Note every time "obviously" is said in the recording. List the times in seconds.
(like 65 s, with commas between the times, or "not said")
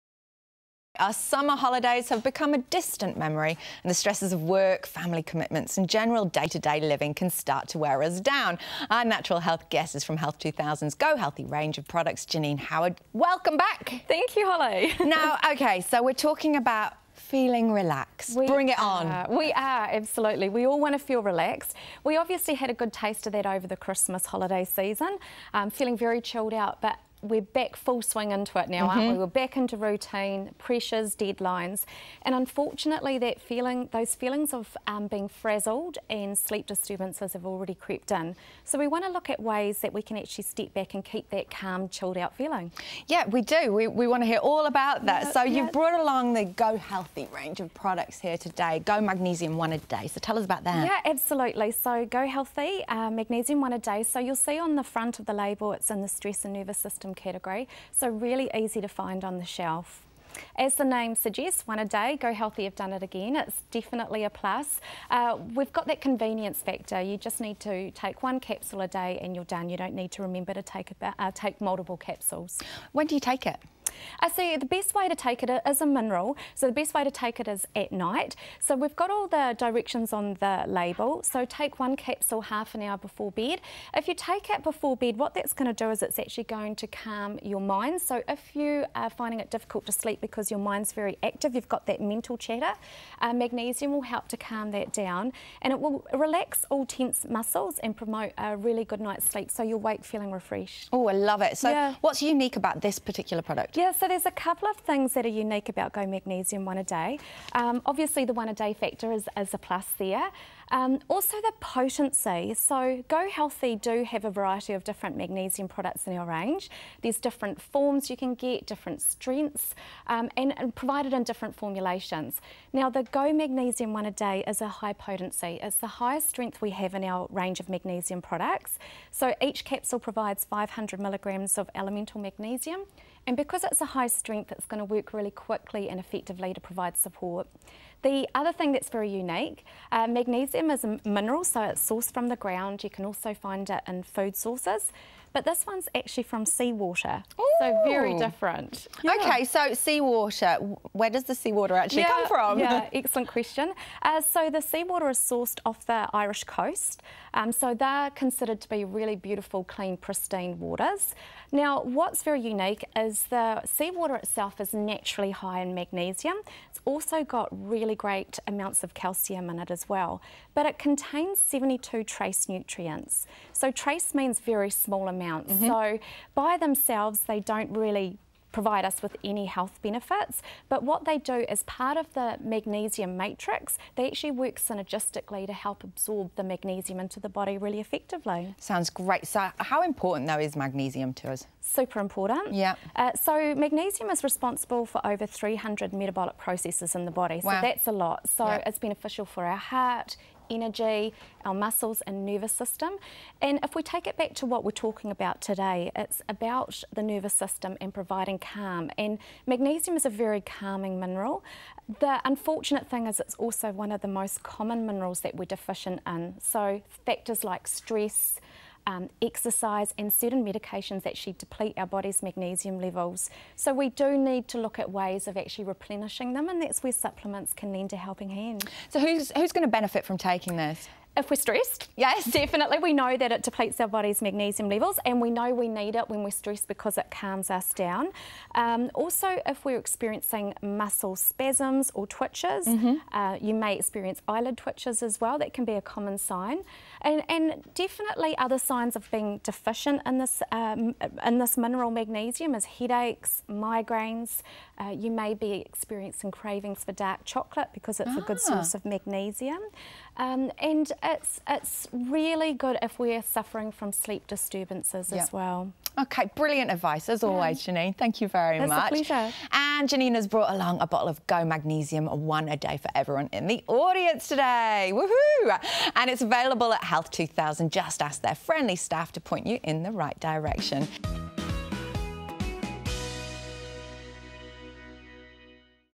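22 s, 107 s.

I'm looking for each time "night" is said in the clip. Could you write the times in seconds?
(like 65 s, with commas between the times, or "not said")
77 s, 99 s.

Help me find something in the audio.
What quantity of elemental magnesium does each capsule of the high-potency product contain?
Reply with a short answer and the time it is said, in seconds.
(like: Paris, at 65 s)
500 milligrams, at 130 s.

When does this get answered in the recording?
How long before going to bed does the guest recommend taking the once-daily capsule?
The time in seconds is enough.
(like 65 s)
82 s.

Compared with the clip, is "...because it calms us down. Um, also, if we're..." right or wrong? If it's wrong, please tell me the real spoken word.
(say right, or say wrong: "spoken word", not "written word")
right.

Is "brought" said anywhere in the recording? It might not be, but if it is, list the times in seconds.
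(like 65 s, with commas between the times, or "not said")
45 s, 270 s.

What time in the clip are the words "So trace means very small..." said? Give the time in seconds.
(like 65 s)
173 s.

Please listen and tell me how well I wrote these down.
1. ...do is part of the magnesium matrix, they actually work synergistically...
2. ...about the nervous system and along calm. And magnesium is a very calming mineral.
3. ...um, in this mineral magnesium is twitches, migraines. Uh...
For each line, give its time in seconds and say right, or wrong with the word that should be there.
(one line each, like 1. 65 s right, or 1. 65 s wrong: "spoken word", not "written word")
1. 181 s right
2. 206 s wrong: "providing", not "along"
3. 250 s wrong: "headaches", not "twitches".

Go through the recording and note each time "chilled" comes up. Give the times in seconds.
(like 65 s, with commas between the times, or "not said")
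26 s, 41 s.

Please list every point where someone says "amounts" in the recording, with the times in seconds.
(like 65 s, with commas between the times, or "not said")
168 s, 175 s.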